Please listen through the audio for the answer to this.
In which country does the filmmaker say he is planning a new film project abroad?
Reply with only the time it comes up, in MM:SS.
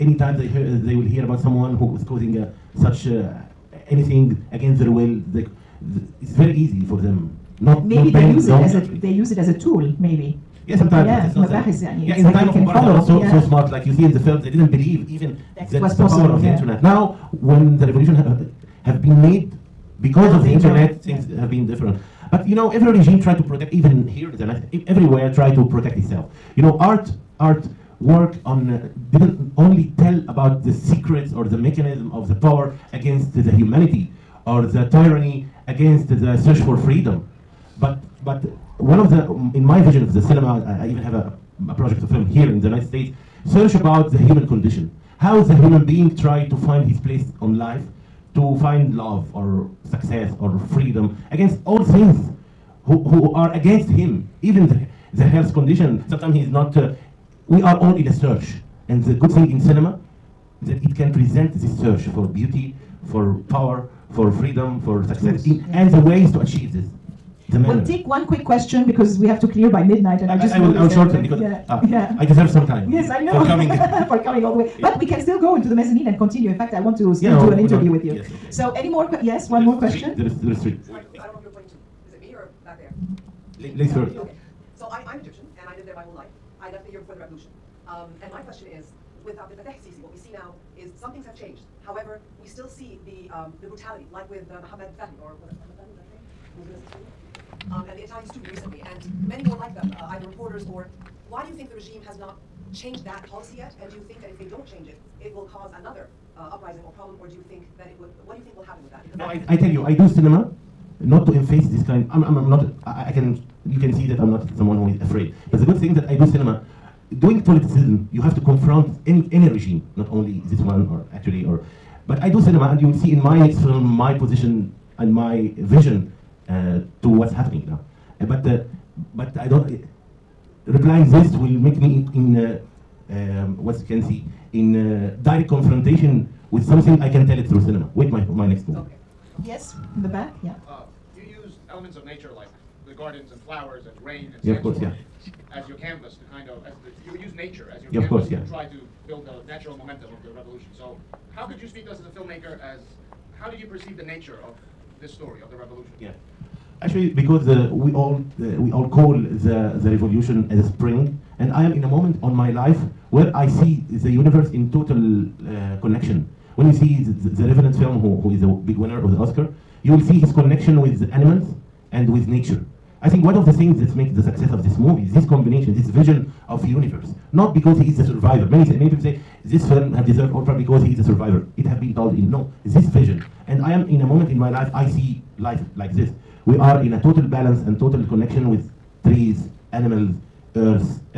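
00:42.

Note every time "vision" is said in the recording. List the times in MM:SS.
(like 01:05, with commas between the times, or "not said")
00:39, 02:05, 02:55, 03:02.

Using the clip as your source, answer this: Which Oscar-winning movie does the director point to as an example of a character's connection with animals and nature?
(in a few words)
The Revenant.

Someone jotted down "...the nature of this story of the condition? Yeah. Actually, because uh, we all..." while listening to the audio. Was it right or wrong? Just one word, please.
wrong.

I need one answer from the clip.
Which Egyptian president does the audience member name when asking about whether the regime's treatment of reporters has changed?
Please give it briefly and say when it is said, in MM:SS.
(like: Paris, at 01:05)
Abdel Fattah Sisi, at 01:29.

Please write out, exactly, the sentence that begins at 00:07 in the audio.
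Not, Maybe not they use it as a they use it as a tool, maybe.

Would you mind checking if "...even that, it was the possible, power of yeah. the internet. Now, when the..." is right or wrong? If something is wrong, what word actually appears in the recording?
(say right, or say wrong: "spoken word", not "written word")
right.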